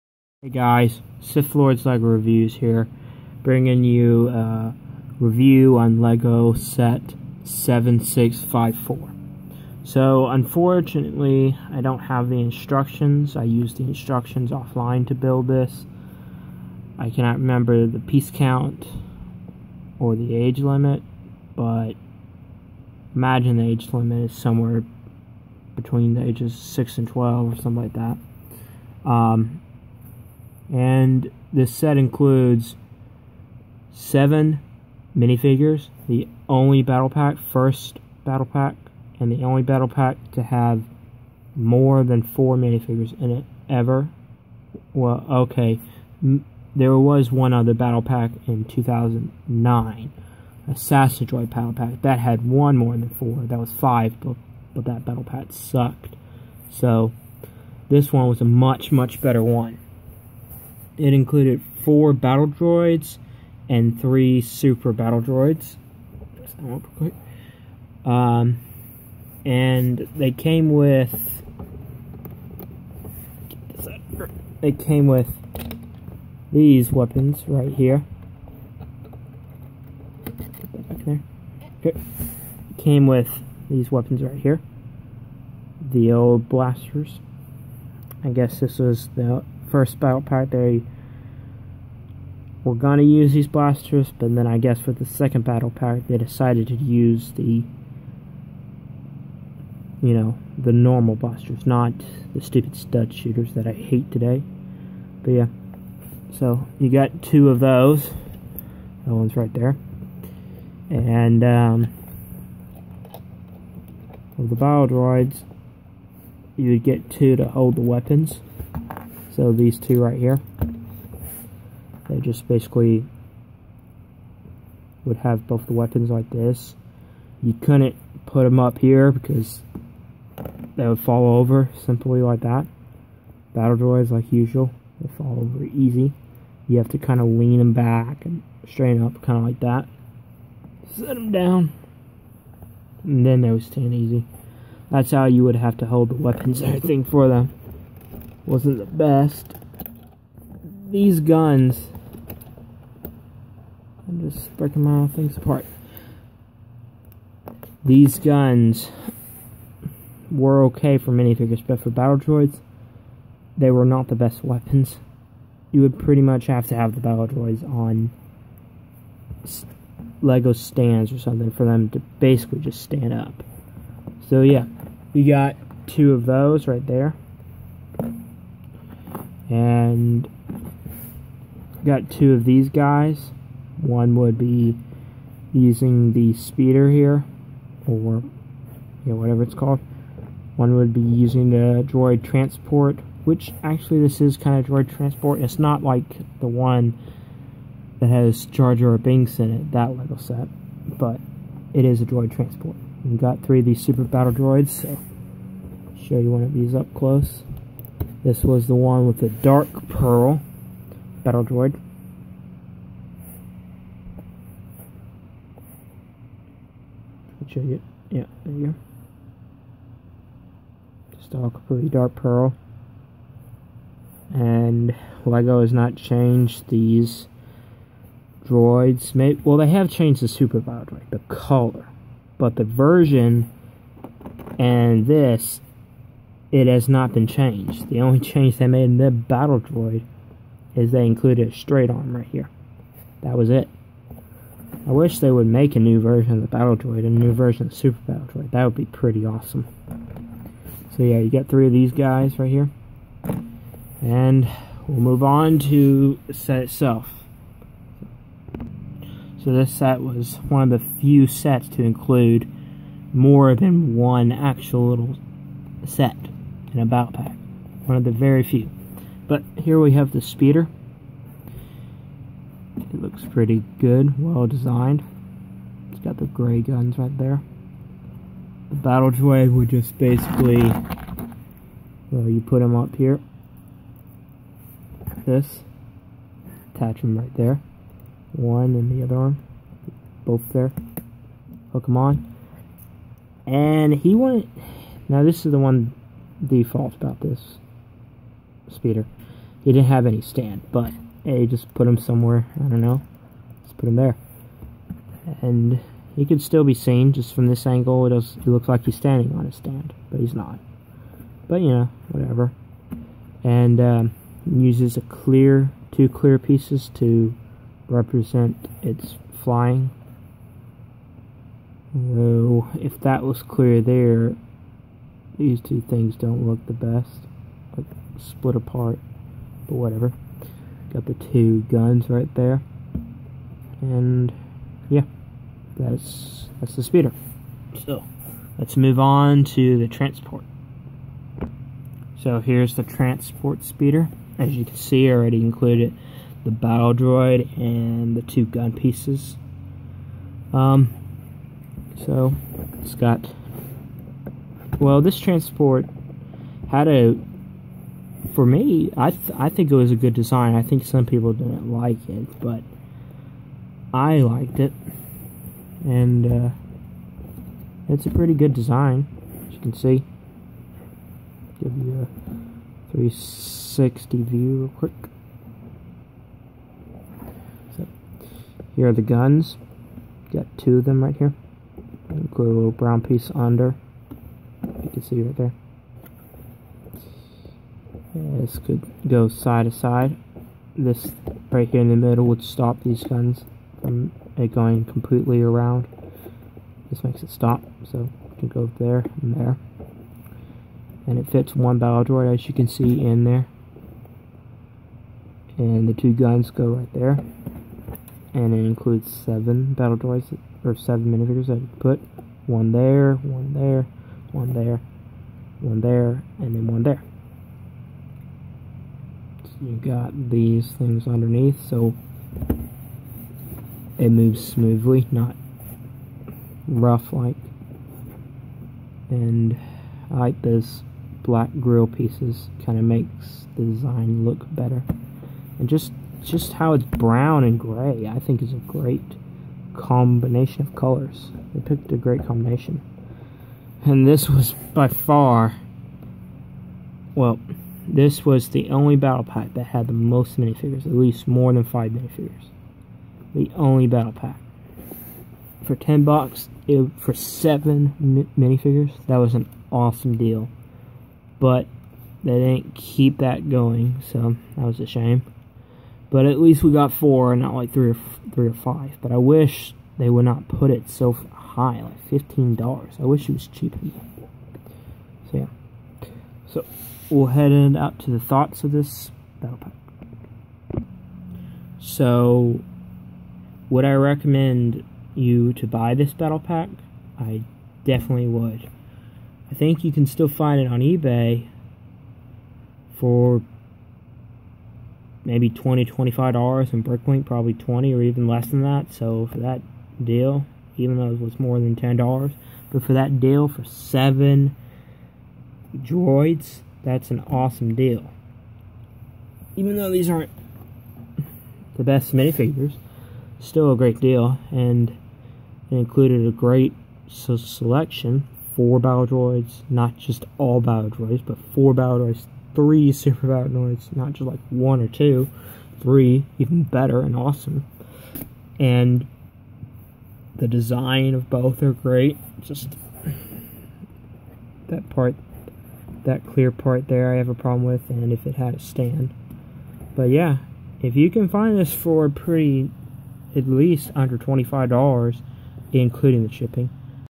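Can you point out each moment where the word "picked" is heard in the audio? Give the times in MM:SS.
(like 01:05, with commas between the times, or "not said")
07:21.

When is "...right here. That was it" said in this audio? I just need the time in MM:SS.
04:02.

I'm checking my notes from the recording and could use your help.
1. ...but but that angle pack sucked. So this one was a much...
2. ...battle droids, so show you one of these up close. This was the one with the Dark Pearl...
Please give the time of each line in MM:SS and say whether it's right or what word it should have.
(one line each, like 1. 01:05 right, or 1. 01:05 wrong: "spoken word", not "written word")
1. 00:54 wrong: "battle", not "angle"
2. 03:24 right.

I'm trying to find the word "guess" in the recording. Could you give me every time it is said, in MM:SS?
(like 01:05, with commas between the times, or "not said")
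01:28, 01:34.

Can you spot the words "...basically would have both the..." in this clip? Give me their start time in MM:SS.
02:02.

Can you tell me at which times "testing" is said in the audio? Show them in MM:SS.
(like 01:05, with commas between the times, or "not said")
not said.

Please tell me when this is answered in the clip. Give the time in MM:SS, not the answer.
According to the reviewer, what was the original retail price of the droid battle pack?
07:35.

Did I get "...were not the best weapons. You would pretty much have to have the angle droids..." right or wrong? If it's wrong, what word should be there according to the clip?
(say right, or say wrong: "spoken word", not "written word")
wrong: "battle", not "angle".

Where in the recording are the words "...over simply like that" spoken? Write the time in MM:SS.
02:11.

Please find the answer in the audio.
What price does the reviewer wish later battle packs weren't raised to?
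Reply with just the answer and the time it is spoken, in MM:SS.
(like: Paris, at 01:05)
$15, at 07:52.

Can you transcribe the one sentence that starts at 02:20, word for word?
Set them down, and then they would stand easy.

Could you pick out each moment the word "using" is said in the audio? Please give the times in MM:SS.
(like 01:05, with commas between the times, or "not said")
03:05, 03:11.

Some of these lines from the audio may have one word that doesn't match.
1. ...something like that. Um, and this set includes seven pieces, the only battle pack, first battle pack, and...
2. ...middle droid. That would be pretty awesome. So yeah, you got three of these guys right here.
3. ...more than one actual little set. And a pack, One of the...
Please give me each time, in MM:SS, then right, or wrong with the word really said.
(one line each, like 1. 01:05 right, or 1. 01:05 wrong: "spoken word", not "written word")
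1. 00:27 wrong: "minifigures", not "pieces"
2. 04:08 wrong: "battle", not "middle"
3. 04:23 right.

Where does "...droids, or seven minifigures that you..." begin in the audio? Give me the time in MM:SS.
06:49.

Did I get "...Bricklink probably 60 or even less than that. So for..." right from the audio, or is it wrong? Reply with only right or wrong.
wrong.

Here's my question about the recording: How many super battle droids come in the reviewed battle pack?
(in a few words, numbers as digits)
3.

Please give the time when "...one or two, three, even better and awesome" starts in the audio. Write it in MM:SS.
08:44.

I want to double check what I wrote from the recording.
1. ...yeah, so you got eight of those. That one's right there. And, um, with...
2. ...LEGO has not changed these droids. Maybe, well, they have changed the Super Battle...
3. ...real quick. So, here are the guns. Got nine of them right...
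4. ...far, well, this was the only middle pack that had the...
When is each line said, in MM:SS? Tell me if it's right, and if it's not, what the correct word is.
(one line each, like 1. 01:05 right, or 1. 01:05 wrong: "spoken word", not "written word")
1. 01:45 wrong: "two", not "eight"
2. 03:45 right
3. 06:14 wrong: "two", not "nine"
4. 07:24 wrong: "battle", not "middle".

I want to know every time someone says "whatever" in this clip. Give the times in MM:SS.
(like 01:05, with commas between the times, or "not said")
03:09, 05:12, 05:29.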